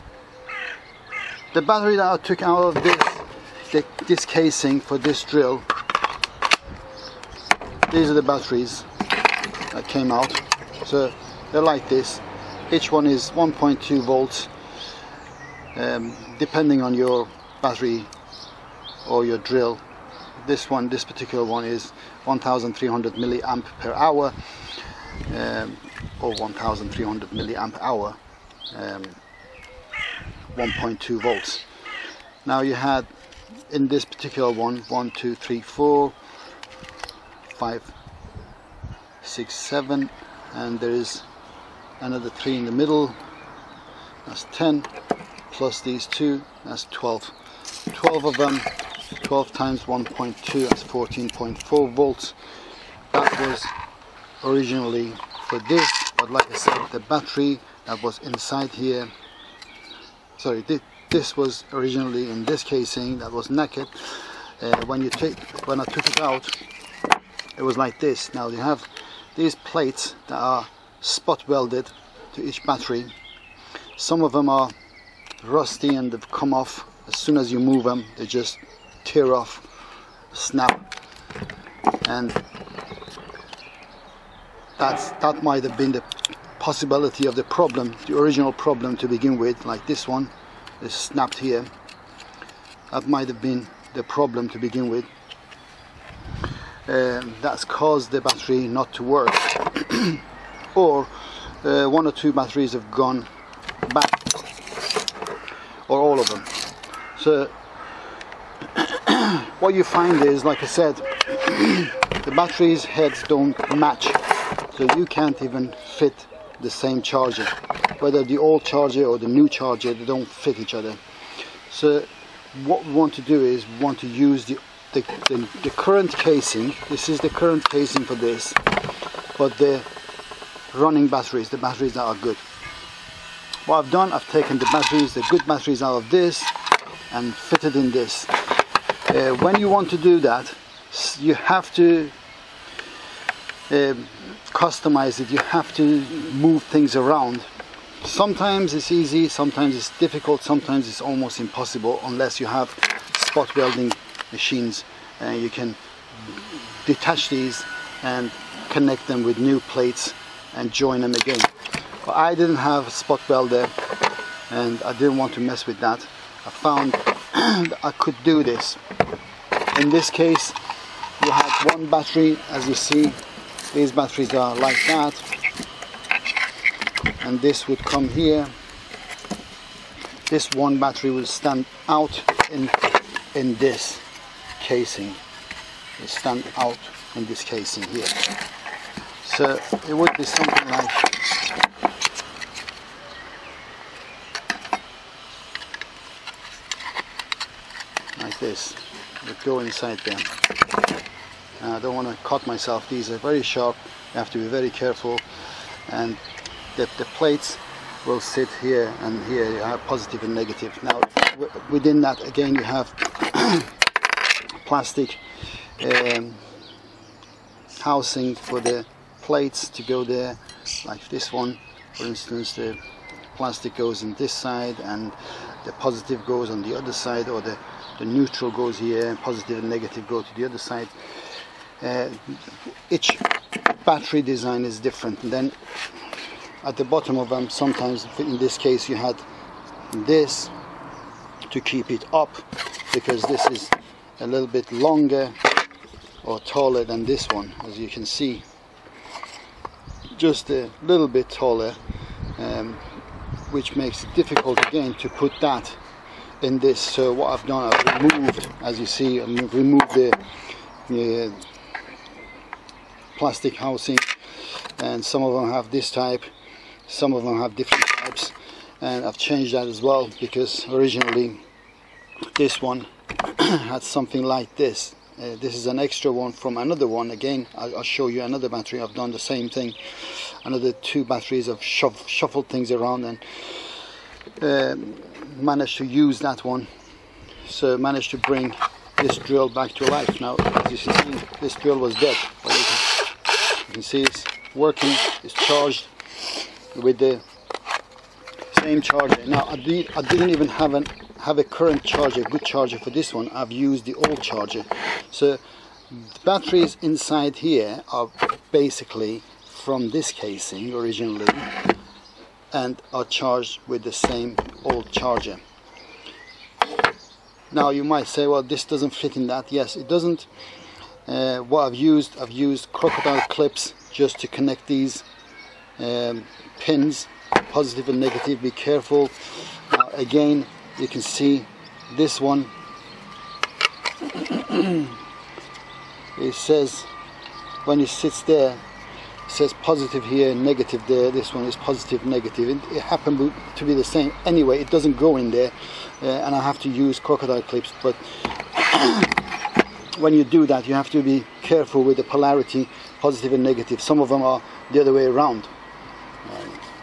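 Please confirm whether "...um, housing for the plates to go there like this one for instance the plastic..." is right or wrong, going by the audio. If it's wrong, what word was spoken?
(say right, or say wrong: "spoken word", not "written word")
right.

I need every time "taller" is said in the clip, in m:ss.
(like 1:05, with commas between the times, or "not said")
4:06, 4:11.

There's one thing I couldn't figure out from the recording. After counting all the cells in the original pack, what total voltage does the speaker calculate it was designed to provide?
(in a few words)
14.4 volts.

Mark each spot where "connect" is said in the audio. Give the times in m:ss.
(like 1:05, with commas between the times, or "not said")
2:38, 5:24.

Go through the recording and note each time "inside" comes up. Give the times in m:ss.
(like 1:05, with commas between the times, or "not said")
0:58, 3:19, 5:06.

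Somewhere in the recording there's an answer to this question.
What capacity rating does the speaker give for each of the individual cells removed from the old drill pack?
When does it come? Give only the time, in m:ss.
0:26.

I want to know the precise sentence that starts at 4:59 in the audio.
Now I, did, I didn't even have, an, have a current charger, good charger for this one.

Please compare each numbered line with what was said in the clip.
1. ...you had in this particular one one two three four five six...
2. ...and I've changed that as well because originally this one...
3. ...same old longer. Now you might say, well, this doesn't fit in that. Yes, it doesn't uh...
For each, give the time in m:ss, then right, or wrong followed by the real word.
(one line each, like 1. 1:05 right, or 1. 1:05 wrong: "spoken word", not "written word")
1. 0:32 right
2. 4:28 right
3. 5:13 wrong: "charger", not "longer".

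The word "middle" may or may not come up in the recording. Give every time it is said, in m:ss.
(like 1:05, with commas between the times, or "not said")
0:42.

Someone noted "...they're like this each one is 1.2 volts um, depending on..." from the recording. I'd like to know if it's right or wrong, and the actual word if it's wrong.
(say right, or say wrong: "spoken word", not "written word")
right.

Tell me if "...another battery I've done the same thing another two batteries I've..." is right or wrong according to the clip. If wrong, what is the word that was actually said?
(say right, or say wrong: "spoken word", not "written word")
right.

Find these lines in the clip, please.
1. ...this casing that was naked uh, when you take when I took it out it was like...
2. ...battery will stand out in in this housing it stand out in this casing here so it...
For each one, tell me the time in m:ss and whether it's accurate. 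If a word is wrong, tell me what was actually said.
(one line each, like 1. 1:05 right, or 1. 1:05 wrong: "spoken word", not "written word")
1. 1:02 right
2. 3:00 wrong: "casing", not "housing".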